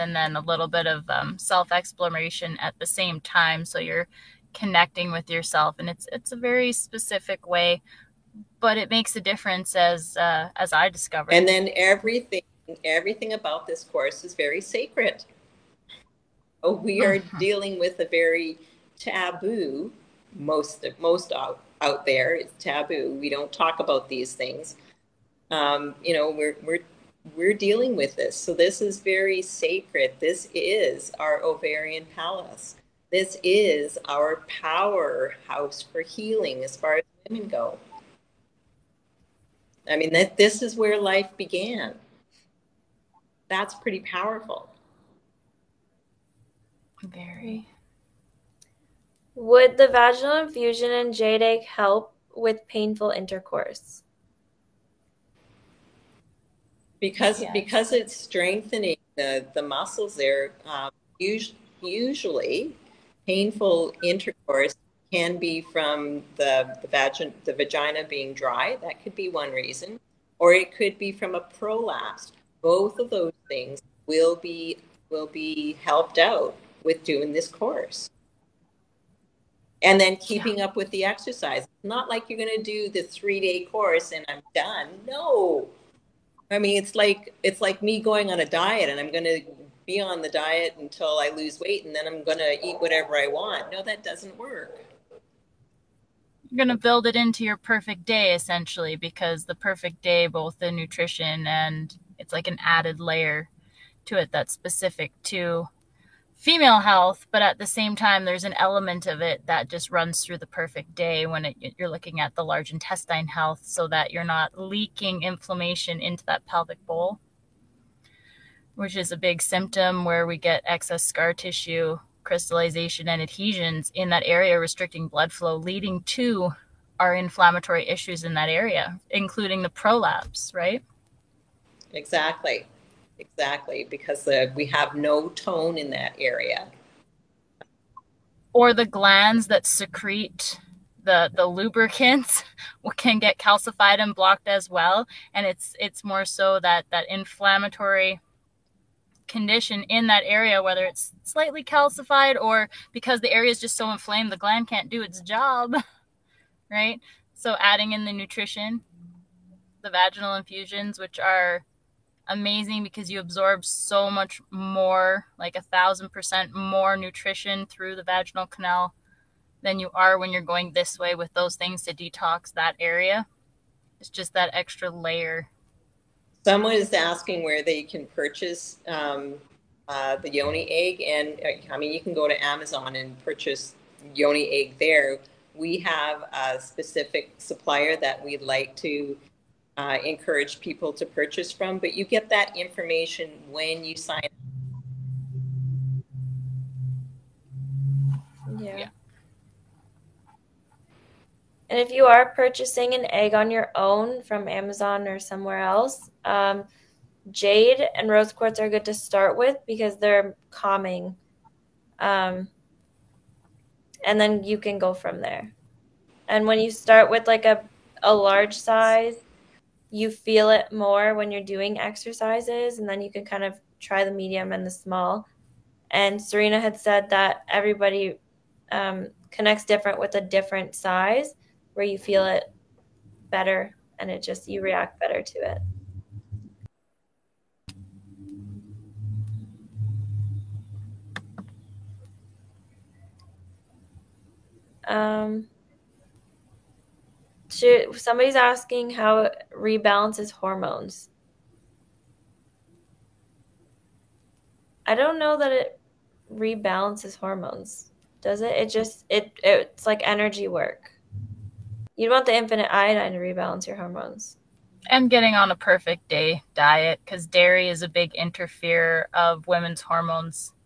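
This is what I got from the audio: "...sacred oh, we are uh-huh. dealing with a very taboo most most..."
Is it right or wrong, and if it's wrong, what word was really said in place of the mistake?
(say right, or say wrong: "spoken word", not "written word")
right.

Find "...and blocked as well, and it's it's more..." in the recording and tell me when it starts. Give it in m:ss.
2:23.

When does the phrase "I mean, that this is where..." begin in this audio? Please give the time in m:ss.
0:39.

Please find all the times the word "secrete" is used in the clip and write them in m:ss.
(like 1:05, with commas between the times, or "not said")
2:19.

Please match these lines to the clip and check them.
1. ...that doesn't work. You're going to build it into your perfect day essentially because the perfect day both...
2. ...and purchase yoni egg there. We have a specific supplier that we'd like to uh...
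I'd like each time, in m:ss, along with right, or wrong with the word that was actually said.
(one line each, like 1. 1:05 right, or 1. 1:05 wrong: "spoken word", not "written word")
1. 1:33 right
2. 3:02 right.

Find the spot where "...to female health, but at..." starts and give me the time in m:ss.
1:45.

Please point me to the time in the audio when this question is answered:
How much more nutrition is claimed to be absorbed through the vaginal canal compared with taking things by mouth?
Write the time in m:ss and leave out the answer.
2:45.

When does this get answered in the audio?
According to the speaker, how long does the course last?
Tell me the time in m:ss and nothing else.
1:23.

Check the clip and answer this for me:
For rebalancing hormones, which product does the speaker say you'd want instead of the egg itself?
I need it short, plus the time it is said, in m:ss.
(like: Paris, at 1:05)
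infinite iodine, at 4:22.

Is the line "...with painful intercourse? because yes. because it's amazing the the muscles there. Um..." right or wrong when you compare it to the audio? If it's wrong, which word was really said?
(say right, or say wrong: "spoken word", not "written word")
wrong: "strengthening", not "amazing".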